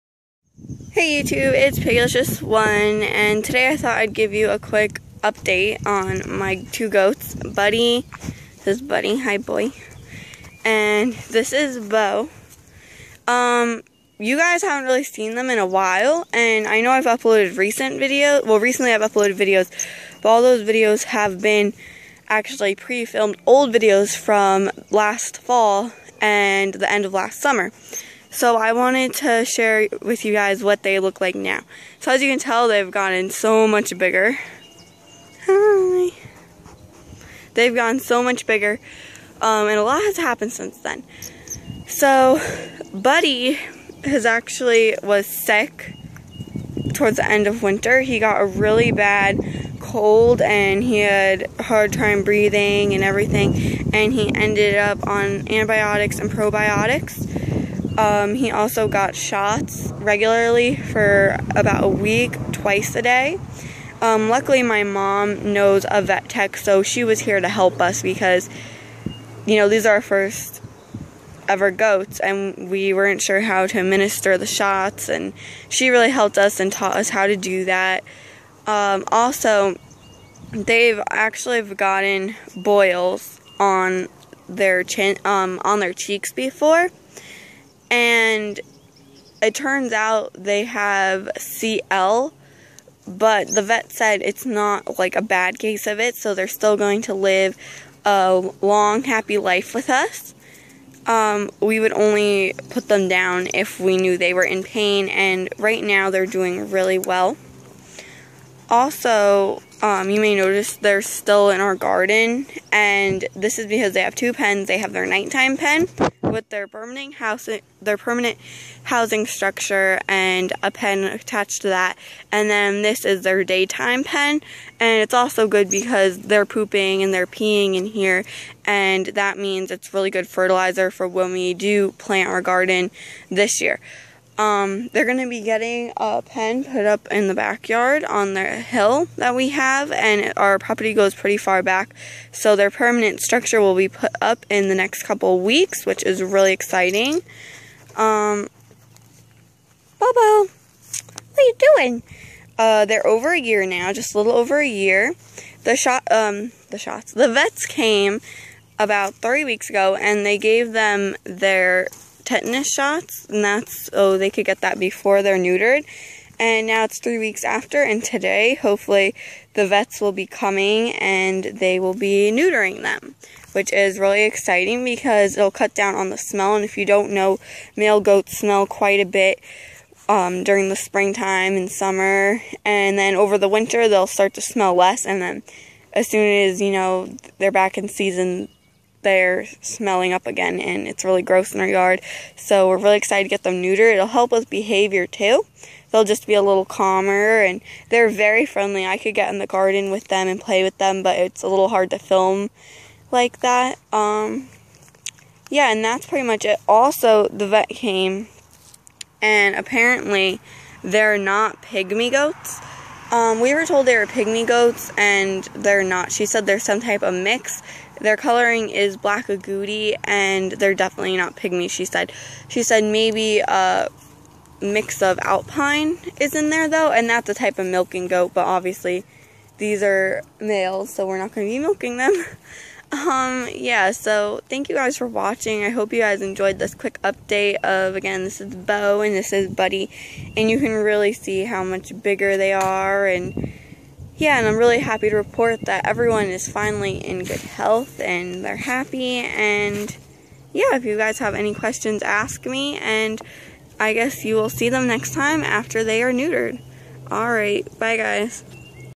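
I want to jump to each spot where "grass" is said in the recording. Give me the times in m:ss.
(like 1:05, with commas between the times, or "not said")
not said.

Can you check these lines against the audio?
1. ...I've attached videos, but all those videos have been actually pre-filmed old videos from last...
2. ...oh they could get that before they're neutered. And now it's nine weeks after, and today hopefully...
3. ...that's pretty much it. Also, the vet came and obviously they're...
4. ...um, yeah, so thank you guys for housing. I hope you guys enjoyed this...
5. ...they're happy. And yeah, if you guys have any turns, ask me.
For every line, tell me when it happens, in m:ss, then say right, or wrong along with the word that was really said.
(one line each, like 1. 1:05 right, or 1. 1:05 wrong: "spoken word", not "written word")
1. 0:18 wrong: "uploaded", not "attached"
2. 2:43 wrong: "three", not "nine"
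3. 3:25 wrong: "apparently", not "obviously"
4. 3:52 wrong: "watching", not "housing"
5. 4:08 wrong: "questions", not "turns".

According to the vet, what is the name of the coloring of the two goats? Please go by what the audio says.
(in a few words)
Black agouti.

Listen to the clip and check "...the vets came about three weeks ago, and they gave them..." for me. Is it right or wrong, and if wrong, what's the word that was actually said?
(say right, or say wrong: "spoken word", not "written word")
right.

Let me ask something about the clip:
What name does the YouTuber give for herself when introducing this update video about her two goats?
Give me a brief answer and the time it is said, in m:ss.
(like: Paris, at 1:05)
Piggylicious1, at 0:01.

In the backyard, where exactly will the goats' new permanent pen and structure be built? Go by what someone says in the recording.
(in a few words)
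On the hill.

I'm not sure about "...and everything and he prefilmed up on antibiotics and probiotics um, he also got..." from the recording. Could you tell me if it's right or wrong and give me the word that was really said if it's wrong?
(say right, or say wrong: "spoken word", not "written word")
wrong: "ended", not "prefilmed".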